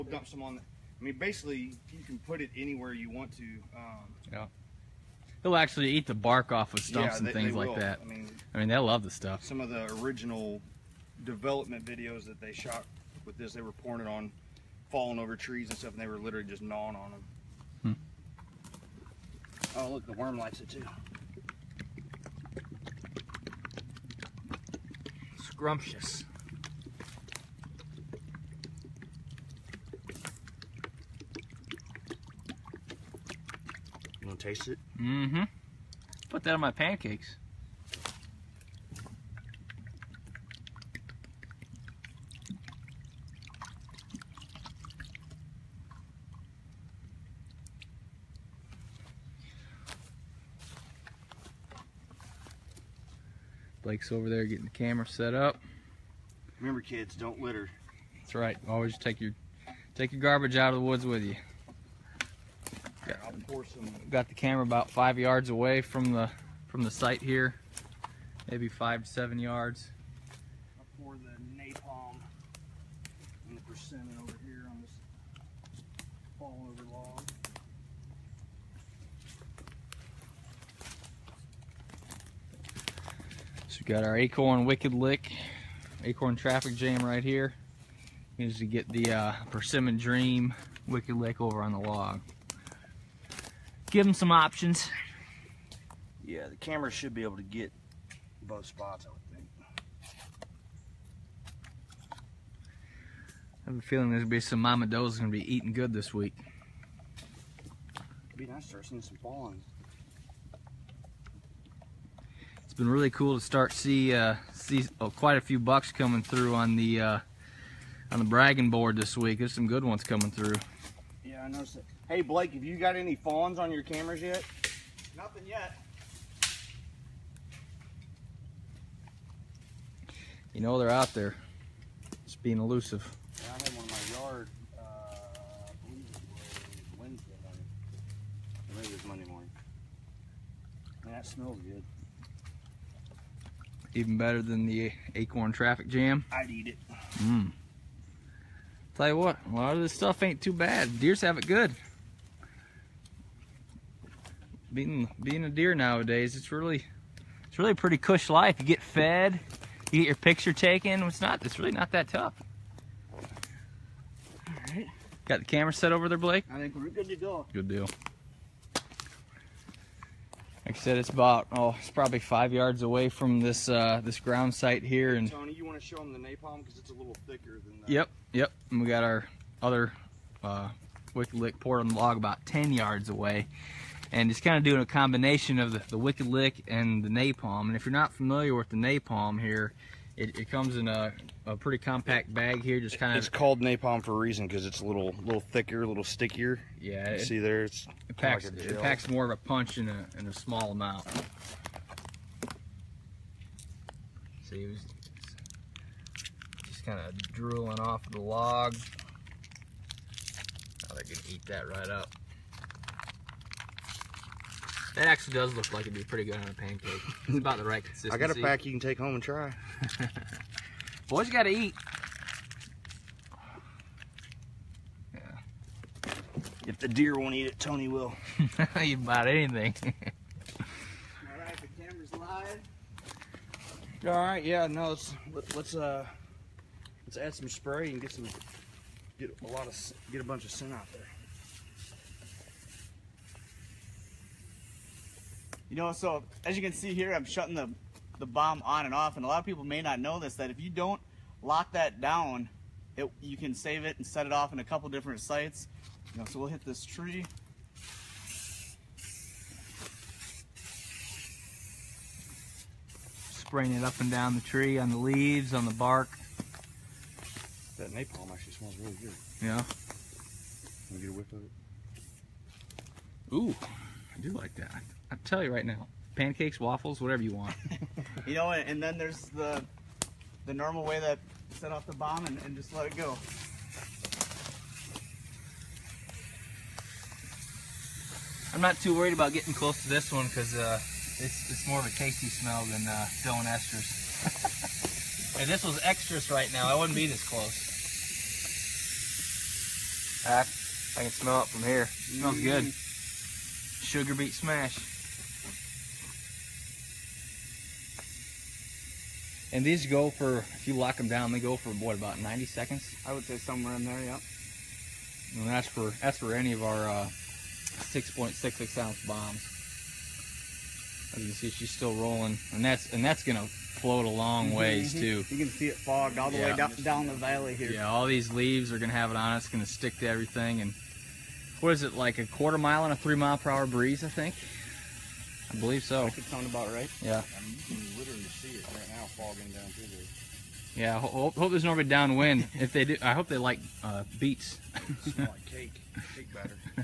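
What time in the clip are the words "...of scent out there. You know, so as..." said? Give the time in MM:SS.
04:00.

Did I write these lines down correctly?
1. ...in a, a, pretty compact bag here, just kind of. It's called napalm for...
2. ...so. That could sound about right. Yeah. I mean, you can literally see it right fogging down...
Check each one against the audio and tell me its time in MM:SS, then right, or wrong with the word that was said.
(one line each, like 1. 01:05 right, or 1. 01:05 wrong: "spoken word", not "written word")
1. 03:10 right
2. 05:35 right.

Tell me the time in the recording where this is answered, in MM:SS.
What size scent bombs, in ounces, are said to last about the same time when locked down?
05:17.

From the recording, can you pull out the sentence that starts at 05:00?
I, I can smell it from here.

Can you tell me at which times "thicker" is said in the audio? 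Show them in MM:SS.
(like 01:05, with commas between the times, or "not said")
02:57, 03:15.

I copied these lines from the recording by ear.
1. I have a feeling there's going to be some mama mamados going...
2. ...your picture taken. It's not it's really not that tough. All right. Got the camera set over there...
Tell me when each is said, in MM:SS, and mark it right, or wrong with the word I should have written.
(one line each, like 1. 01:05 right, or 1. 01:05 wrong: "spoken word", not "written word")
1. 01:43 right
2. 02:40 right.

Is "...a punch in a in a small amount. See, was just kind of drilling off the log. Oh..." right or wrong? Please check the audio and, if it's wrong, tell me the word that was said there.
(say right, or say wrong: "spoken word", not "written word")
right.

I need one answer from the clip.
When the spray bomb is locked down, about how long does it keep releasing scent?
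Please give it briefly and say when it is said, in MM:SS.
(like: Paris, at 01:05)
90 seconds, at 05:12.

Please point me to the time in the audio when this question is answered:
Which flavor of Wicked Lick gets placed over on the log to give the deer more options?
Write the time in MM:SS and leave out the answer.
01:29.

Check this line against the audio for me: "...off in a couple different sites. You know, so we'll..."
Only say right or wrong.
right.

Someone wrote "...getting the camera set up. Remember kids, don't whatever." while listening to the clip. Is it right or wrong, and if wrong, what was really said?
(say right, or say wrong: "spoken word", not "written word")
wrong: "litter", not "whatever".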